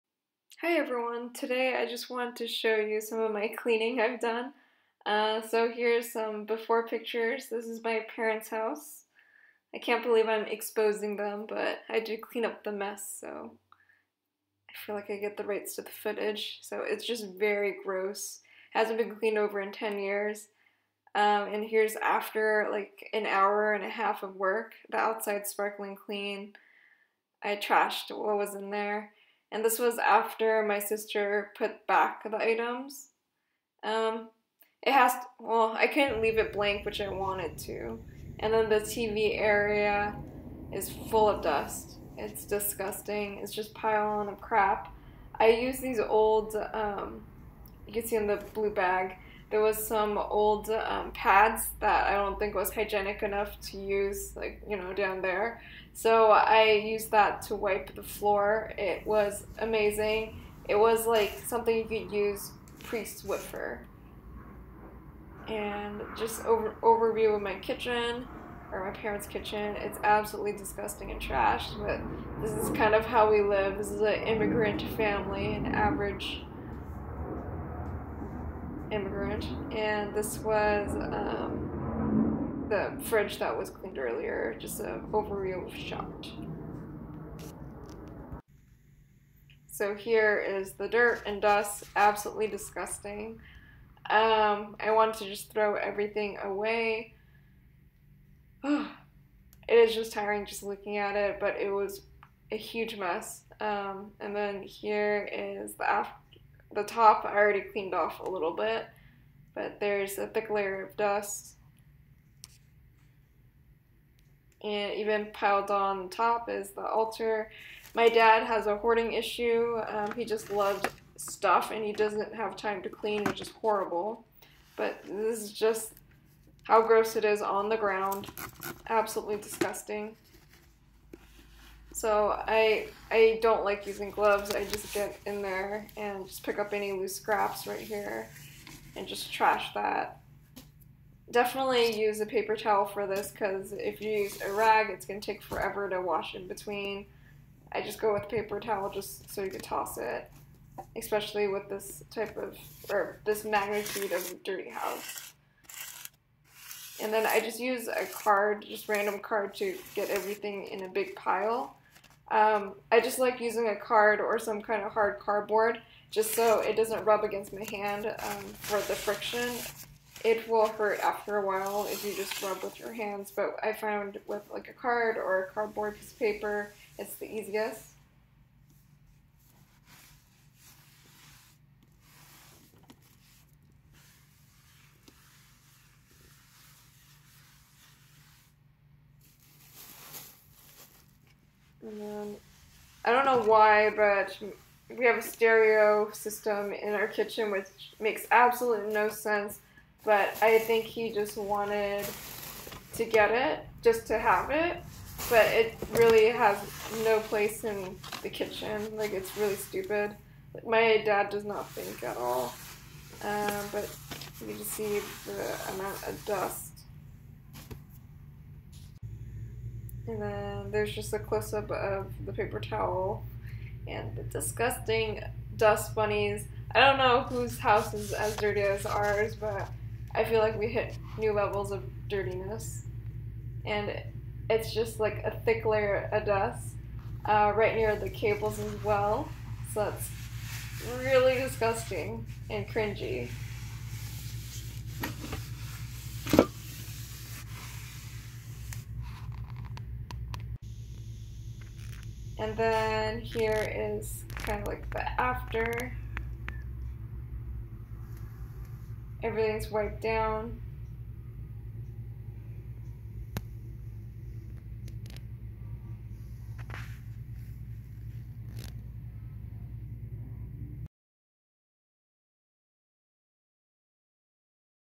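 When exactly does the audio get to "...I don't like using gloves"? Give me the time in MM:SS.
02:13.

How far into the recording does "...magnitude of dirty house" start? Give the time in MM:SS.
02:33.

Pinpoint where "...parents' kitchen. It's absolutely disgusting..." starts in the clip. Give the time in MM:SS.
01:09.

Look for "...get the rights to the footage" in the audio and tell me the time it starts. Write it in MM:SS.
00:15.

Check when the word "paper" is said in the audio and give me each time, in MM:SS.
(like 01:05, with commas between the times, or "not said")
02:22, 02:28, 02:56, 03:42.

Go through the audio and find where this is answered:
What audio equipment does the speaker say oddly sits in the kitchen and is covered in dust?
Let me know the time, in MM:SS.
03:15.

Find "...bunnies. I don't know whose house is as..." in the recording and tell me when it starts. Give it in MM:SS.
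03:45.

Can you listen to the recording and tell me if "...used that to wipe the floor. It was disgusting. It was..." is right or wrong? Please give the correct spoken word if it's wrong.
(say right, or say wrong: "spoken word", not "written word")
wrong: "amazing", not "disgusting".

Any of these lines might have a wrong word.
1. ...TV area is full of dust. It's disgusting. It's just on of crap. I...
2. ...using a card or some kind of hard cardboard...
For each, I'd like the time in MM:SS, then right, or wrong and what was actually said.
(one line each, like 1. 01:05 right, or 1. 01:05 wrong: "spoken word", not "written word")
1. 00:38 right
2. 02:43 right.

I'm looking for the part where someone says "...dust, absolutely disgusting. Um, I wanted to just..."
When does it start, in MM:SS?
01:31.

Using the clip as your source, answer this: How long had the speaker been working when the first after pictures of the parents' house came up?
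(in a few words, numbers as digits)
an hour and a half.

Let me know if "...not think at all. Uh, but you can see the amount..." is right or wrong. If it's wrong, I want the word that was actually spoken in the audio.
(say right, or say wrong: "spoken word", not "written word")
right.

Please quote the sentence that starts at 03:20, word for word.
But I think he just wanted to get it, just to have it.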